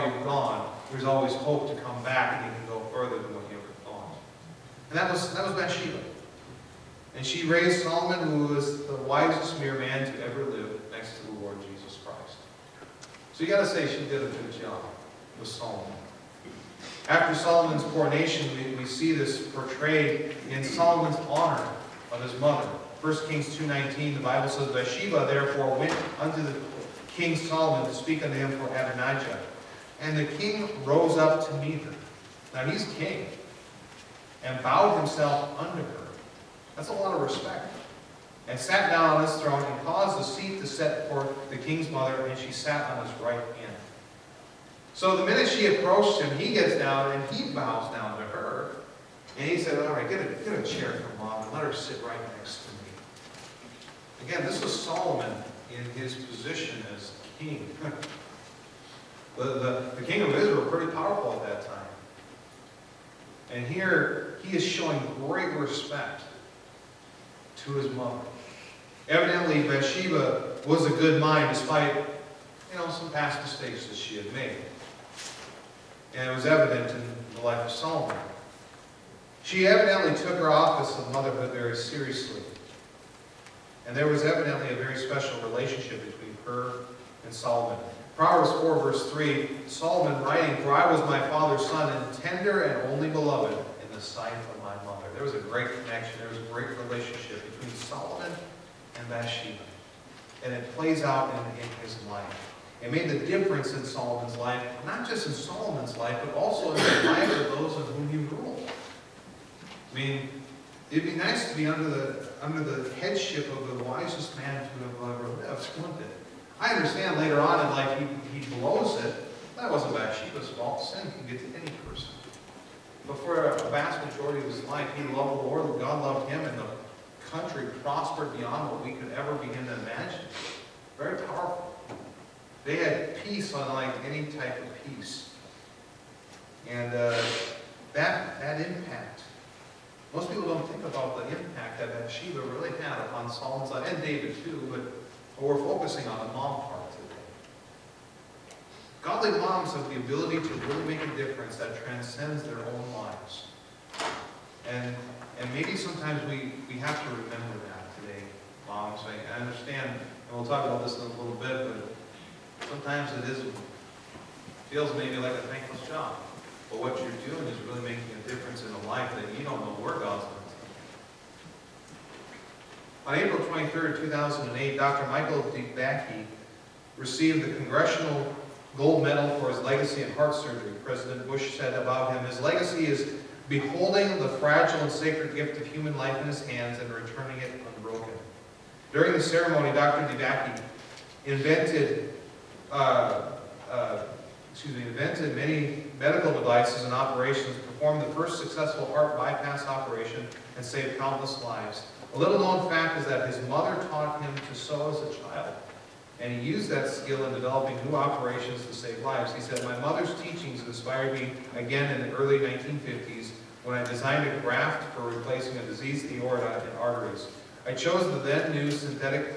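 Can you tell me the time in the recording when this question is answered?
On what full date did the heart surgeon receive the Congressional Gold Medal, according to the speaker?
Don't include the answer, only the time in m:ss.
2:53.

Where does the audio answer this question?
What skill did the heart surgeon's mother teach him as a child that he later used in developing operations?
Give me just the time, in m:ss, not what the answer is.
3:24.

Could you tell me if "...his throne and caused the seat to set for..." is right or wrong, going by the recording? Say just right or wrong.
right.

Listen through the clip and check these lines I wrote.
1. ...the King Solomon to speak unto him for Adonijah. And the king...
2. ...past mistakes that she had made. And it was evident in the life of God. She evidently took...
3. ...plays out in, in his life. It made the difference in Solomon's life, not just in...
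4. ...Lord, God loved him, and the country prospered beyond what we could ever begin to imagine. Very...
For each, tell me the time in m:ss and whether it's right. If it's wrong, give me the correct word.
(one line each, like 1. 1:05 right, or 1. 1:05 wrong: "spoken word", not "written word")
1. 0:26 right
2. 1:13 wrong: "Solomon", not "God"
3. 1:40 right
4. 2:05 right.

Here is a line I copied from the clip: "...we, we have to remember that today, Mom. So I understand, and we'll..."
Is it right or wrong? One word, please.
right.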